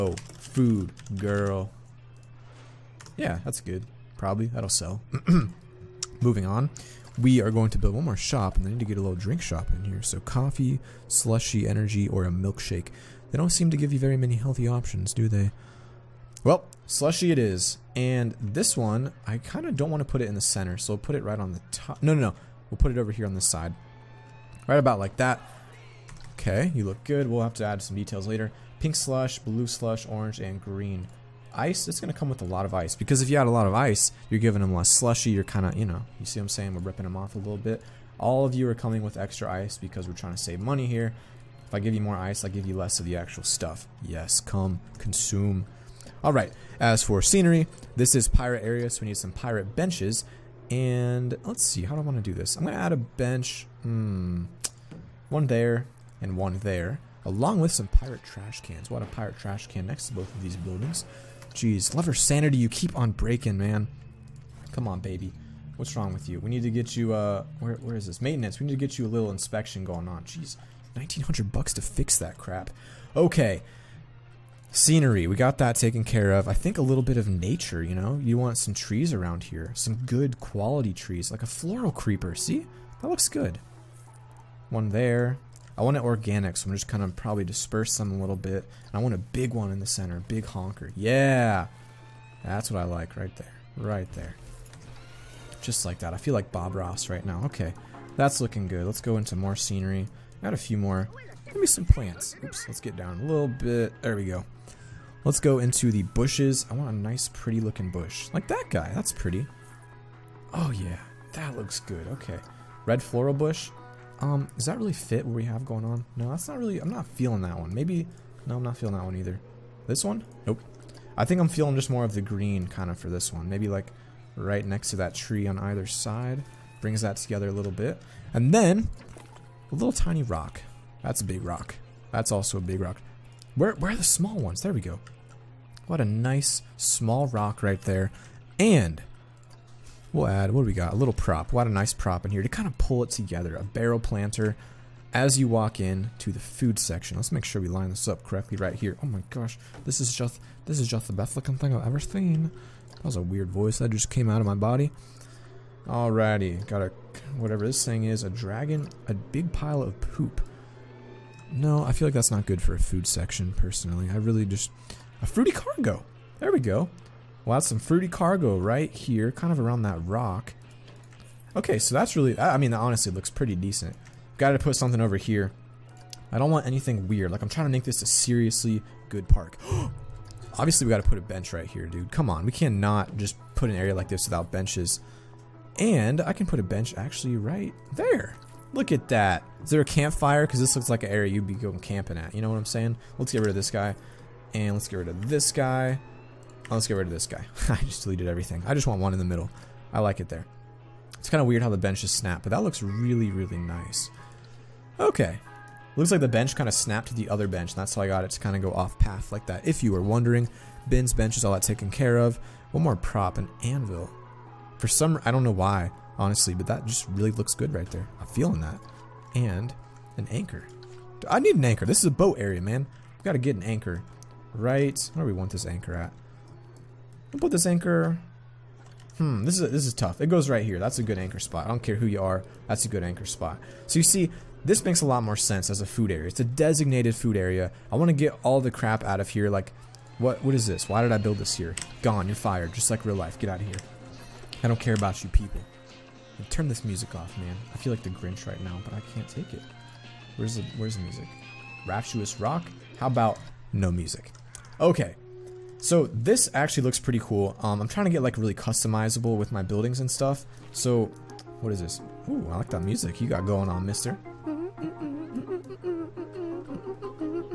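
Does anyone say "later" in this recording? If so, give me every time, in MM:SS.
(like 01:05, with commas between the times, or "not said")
00:28.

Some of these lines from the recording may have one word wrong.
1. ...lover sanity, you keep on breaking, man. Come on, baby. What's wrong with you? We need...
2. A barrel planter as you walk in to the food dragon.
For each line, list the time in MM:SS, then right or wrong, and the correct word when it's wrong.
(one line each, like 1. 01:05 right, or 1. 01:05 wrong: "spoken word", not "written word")
1. 01:01 right
2. 02:23 wrong: "section", not "dragon".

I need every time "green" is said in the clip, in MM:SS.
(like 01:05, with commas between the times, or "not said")
00:30, 02:02.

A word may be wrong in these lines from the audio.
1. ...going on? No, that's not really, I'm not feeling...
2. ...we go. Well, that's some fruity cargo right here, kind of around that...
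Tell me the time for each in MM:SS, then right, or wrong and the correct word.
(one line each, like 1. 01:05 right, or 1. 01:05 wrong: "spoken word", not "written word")
1. 01:55 right
2. 02:46 right.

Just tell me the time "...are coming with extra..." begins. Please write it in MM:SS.
00:38.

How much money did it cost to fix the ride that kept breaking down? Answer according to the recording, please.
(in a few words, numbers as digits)
1900 bucks.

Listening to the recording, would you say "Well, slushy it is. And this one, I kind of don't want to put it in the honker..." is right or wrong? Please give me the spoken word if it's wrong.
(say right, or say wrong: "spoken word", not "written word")
wrong: "center", not "honker".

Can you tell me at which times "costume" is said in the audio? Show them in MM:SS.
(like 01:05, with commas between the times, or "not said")
not said.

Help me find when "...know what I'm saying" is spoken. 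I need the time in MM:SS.
03:12.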